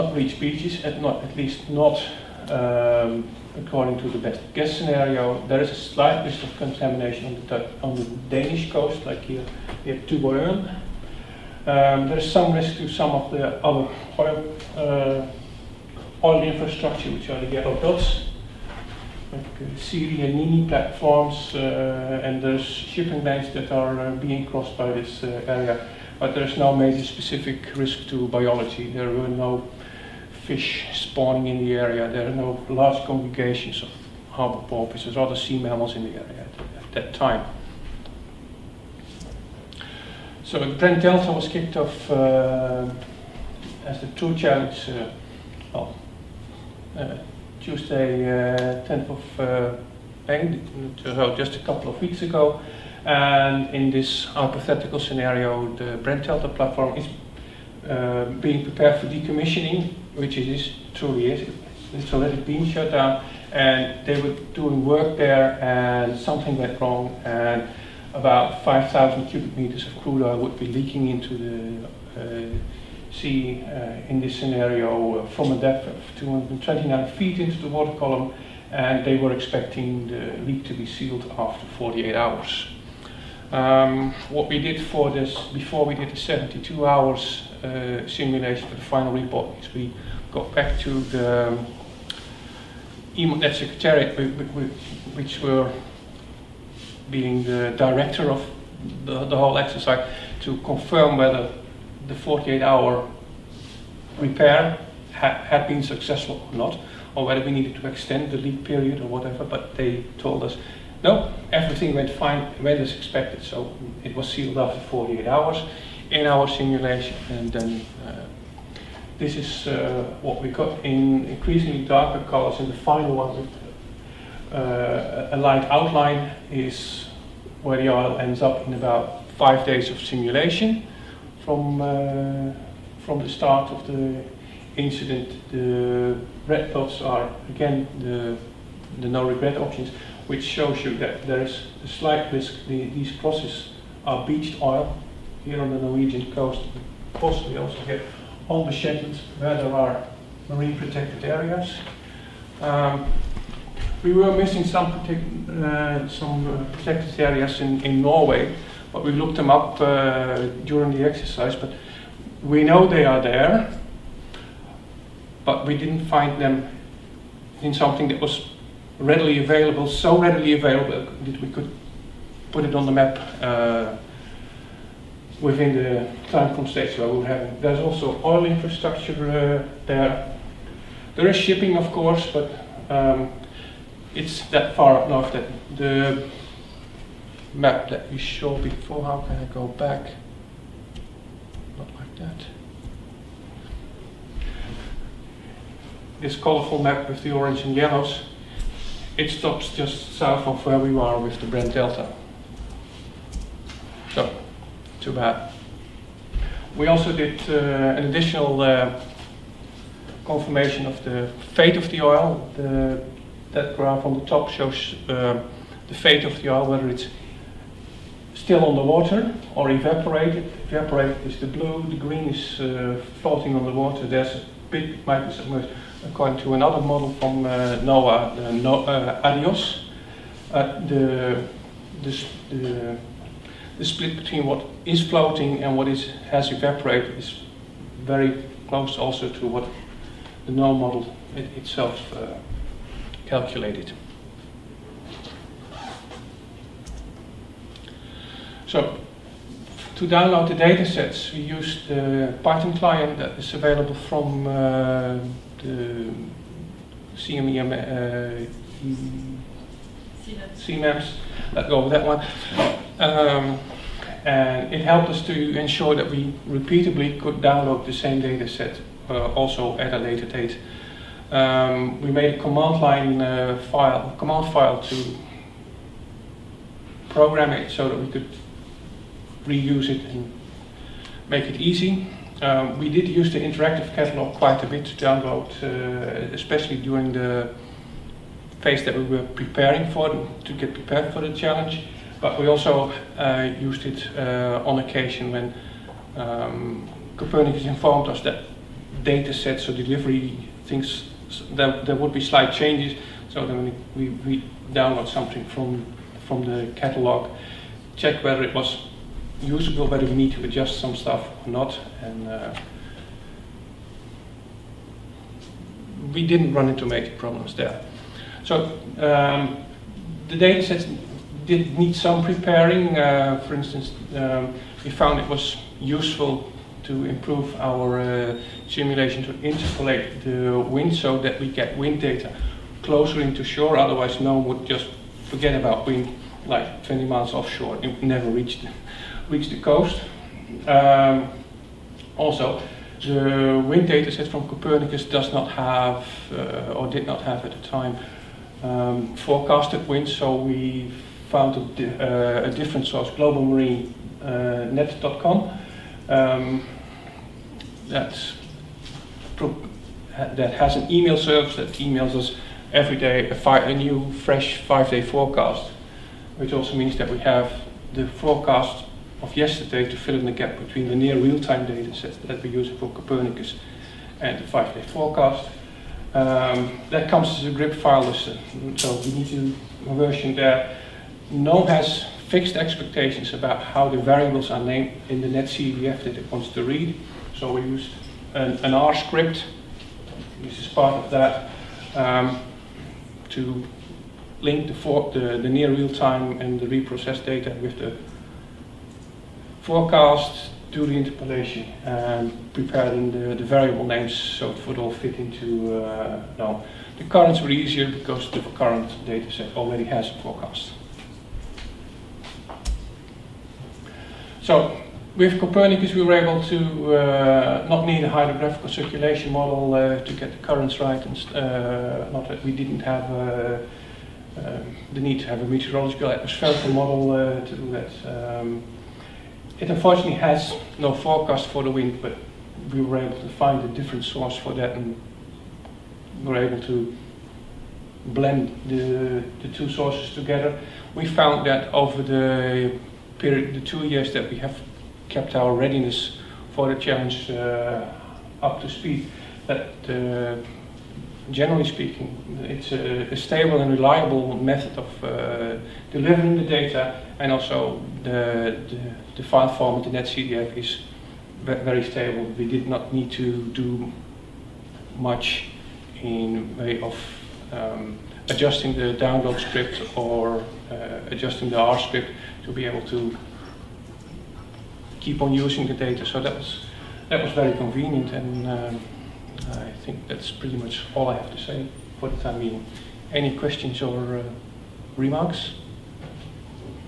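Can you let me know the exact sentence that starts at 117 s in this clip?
And then uh, this is uh, what we got in increasingly darker colors.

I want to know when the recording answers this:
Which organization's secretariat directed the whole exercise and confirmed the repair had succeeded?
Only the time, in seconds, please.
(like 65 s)
93 s.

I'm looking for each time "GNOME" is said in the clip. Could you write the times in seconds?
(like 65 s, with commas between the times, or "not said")
240 s, 406 s.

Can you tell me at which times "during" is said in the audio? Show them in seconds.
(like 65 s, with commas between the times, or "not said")
160 s, 286 s.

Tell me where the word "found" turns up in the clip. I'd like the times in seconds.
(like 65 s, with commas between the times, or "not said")
324 s, 351 s, 441 s.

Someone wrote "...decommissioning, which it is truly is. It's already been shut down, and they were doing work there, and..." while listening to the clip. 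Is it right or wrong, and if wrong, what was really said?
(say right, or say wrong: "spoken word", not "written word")
right.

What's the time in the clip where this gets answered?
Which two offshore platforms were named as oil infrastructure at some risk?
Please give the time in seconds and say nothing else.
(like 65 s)
19 s.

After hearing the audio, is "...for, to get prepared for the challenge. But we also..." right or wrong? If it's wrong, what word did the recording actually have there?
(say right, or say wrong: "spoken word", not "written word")
right.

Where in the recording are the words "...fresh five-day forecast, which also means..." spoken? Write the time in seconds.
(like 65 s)
364 s.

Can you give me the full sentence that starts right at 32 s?
There are no large congregations of harbor porpoises or other sea mammals in the area at, that time.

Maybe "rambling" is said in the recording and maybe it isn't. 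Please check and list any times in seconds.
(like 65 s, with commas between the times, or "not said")
not said.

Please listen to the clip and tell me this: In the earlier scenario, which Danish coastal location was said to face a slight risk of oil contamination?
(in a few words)
Tuborg.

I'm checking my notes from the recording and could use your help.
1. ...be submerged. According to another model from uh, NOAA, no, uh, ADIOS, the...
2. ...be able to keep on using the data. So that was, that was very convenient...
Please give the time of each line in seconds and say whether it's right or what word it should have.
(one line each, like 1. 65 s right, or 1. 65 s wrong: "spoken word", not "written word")
1. 225 s right
2. 472 s right.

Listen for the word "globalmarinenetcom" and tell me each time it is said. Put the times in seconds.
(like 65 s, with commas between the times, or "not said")
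353 s.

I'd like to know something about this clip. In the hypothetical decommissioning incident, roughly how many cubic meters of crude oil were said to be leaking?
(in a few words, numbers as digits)
5,000.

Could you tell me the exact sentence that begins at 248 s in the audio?
So to download the data sets, we use the Python client that is available from uh, the CMEM uh, CMAPs.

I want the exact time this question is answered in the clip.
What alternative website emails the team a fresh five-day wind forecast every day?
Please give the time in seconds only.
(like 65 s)
353 s.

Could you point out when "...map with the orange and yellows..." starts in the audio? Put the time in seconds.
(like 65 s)
196 s.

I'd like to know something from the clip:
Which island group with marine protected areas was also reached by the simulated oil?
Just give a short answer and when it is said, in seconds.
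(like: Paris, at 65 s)
Shetlands, at 148 s.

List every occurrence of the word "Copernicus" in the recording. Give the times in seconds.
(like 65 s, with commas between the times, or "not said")
297 s, 344 s, 372 s, 415 s.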